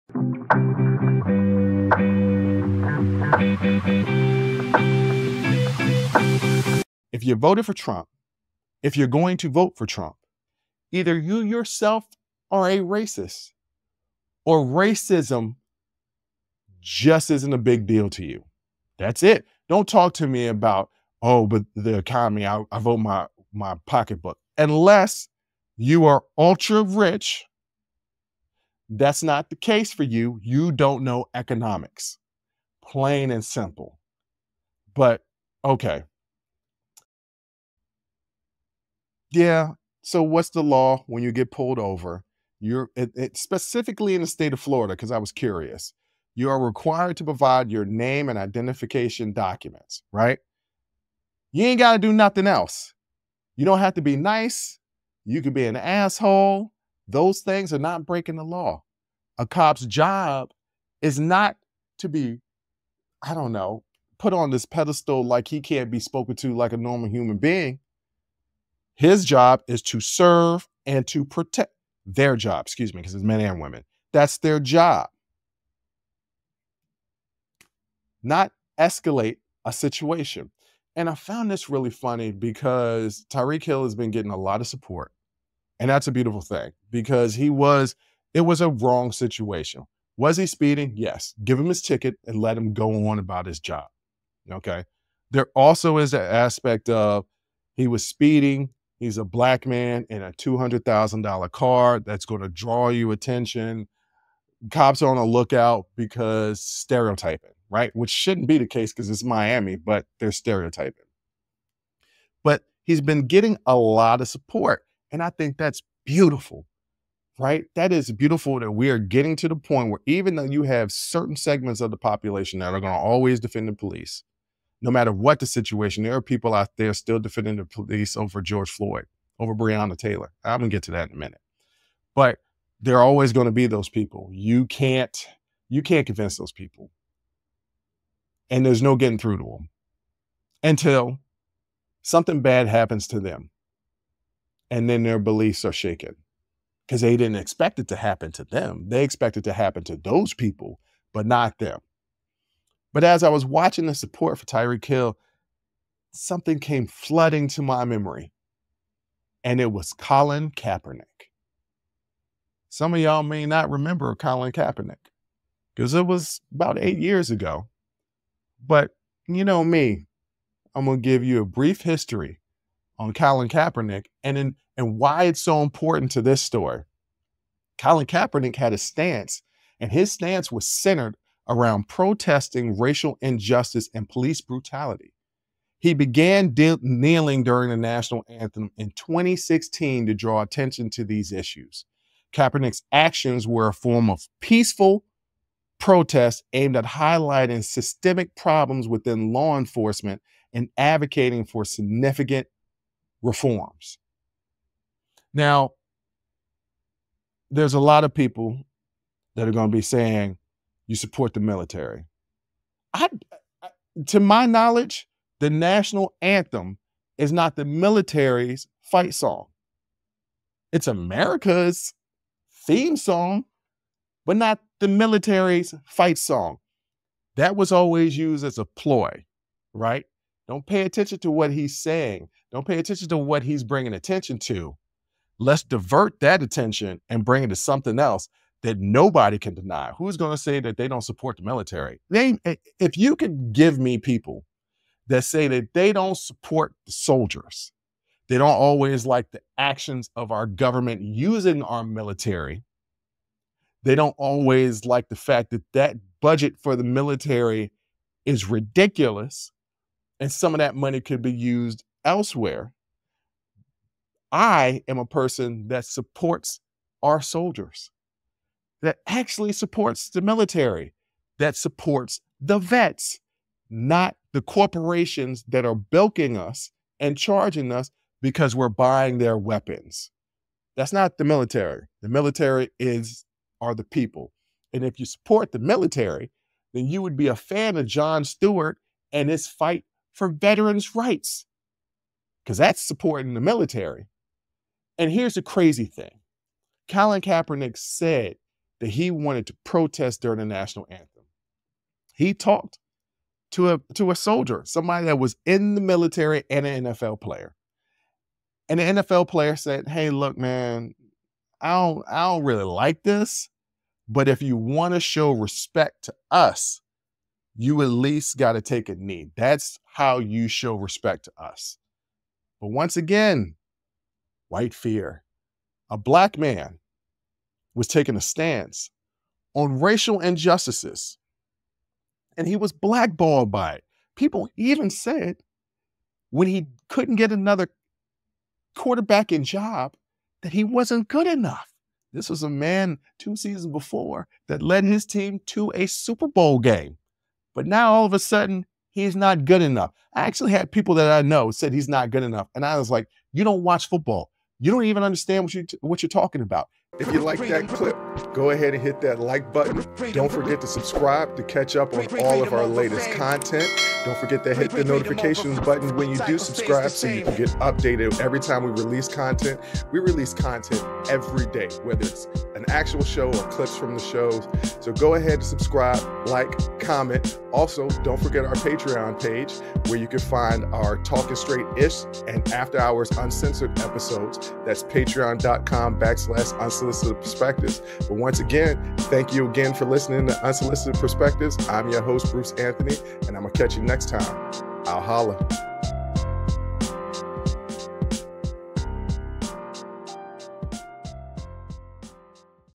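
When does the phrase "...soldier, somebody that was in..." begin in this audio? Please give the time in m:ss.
5:04.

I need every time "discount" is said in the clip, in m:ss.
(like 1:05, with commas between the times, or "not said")
not said.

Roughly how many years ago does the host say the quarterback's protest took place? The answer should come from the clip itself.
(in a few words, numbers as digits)
8.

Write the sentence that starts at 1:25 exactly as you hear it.
And that's a beautiful thing because he was, it was a wrong situation.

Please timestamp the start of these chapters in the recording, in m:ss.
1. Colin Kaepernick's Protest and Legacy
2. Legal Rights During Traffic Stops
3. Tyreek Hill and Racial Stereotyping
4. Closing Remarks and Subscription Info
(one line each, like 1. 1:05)
1. 2:39
2. 0:39
3. 1:20
4. 5:56.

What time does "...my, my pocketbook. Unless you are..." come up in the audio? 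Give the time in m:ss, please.
0:22.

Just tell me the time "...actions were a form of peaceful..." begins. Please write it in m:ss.
3:12.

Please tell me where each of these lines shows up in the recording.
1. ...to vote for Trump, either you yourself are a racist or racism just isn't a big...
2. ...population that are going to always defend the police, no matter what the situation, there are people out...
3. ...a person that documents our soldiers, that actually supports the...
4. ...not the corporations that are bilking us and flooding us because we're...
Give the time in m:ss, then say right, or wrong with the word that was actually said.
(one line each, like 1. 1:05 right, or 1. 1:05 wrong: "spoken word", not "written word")
1. 0:09 right
2. 2:01 right
3. 4:24 wrong: "supports", not "documents"
4. 4:33 wrong: "charging", not "flooding".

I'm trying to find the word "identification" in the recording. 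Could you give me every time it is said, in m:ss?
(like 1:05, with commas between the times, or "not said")
0:48.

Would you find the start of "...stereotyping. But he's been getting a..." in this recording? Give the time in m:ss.
1:50.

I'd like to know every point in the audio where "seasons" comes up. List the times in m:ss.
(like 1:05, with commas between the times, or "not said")
5:43.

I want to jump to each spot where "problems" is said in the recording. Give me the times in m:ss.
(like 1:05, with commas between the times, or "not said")
3:18.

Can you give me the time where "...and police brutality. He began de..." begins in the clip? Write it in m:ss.
3:03.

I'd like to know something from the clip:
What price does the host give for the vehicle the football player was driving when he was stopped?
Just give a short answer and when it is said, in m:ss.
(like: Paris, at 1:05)
$200,000, at 1:40.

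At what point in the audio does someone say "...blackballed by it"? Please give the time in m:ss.
5:32.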